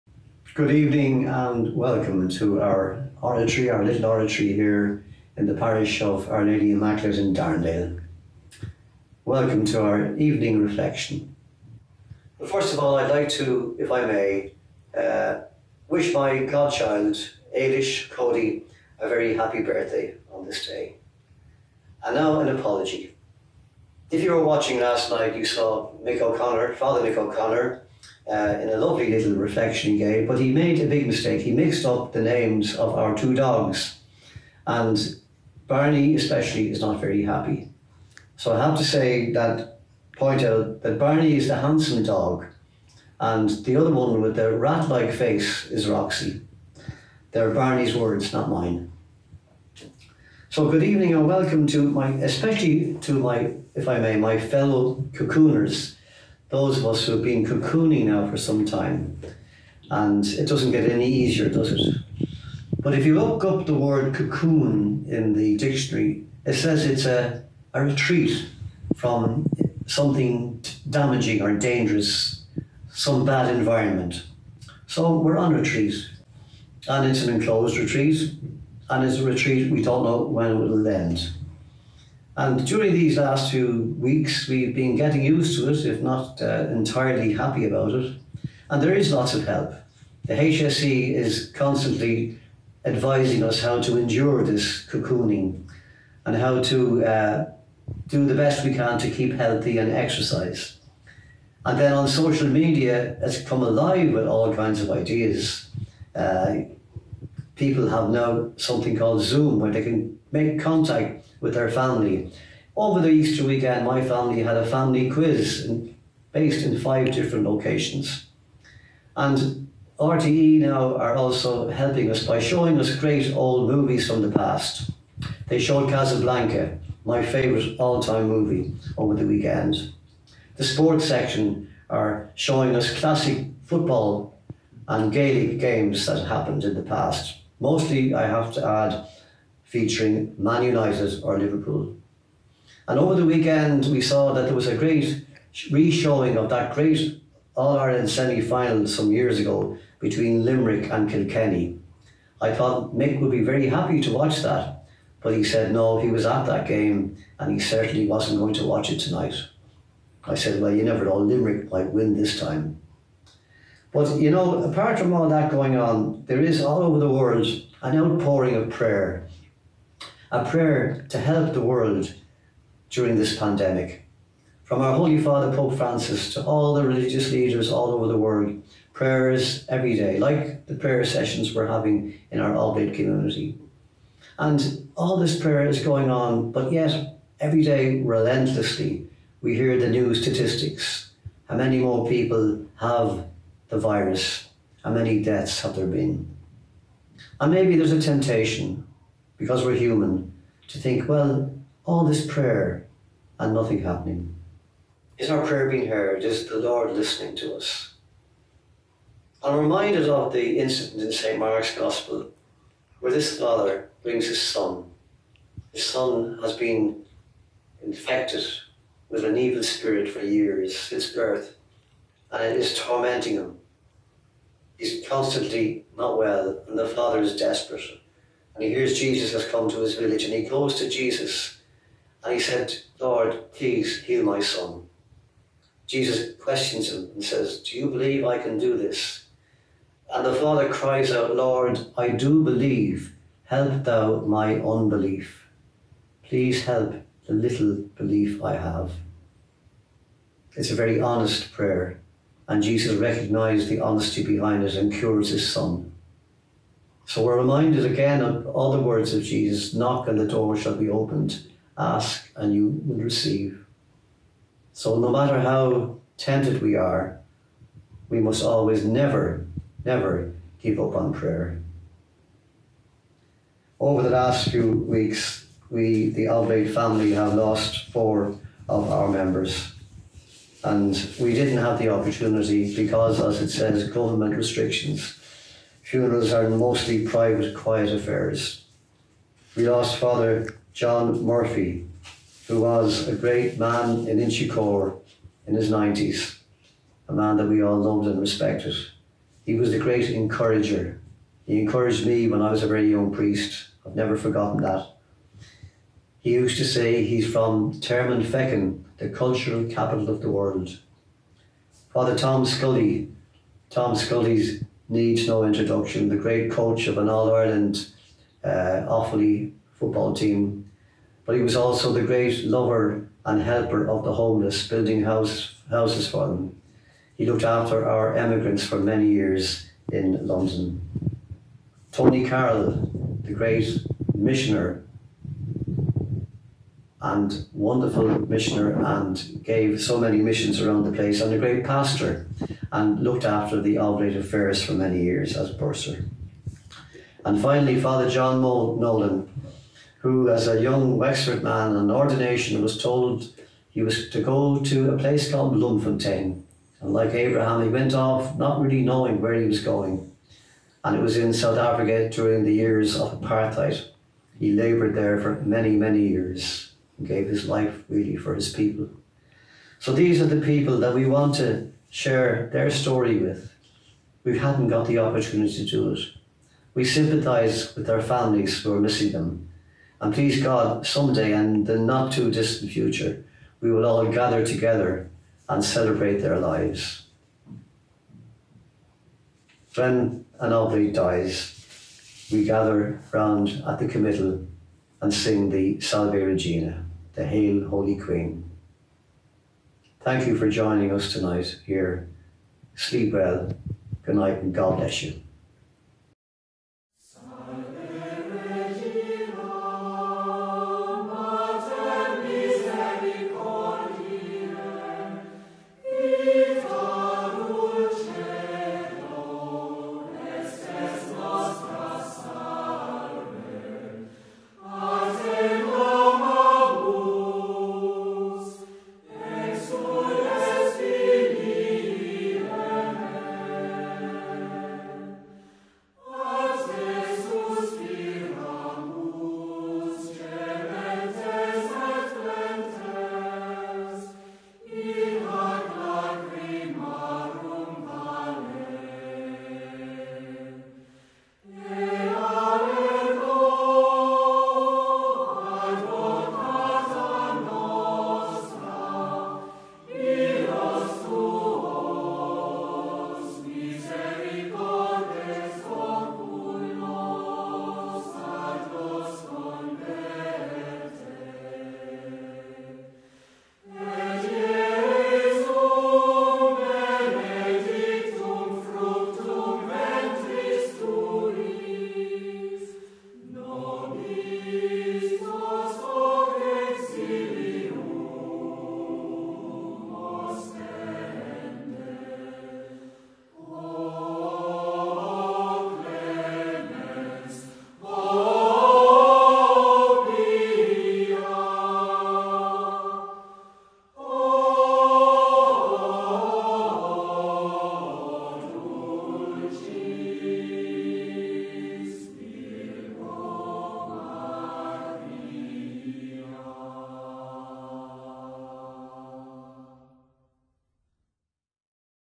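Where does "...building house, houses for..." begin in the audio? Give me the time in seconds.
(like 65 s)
324 s.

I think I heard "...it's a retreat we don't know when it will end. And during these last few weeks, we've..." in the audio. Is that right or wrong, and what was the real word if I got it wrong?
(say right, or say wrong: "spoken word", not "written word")
right.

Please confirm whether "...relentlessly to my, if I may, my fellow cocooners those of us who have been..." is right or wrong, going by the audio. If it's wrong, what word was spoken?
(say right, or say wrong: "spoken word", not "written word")
wrong: "especially", not "relentlessly".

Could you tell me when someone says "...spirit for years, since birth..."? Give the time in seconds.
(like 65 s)
219 s.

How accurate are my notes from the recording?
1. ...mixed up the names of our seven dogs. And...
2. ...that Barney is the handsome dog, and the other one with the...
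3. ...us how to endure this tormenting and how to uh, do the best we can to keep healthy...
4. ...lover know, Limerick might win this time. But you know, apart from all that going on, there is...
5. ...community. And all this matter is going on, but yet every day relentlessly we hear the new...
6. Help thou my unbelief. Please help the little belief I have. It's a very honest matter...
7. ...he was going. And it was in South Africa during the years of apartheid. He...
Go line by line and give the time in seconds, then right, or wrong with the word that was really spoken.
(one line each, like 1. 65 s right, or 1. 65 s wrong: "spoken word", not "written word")
1. 31 s wrong: "two", not "seven"
2. 40 s right
3. 93 s wrong: "cocooning", not "tormenting"
4. 160 s wrong: "never", not "lover"
5. 182 s wrong: "prayer", not "matter"
6. 243 s wrong: "prayer", not "matter"
7. 359 s right.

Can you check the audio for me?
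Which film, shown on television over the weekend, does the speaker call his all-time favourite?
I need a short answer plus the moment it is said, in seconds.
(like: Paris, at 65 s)
Casablanca, at 125 s.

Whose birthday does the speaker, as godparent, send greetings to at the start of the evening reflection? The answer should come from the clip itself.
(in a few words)
Ailish Cody.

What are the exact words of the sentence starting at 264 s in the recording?
So no matter how tempted we are, we must always never, never give up on prayer.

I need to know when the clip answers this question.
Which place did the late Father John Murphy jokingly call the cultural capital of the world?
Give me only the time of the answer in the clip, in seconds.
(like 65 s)
307 s.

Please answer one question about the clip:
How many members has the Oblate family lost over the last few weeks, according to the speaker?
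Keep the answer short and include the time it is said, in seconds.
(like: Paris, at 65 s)
4, at 277 s.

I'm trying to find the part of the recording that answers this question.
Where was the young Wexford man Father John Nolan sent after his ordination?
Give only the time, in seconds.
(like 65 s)
355 s.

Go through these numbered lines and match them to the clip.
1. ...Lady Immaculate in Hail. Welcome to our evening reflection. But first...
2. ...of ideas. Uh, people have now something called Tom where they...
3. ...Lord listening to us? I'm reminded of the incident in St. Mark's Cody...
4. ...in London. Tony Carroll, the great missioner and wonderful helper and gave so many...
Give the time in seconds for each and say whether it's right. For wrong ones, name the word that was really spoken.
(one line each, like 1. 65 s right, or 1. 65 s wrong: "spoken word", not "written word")
1. 6 s wrong: "Darndale", not "Hail"
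2. 104 s wrong: "Zoom", not "Tom"
3. 206 s wrong: "Gospel", not "Cody"
4. 329 s wrong: "missioner", not "helper".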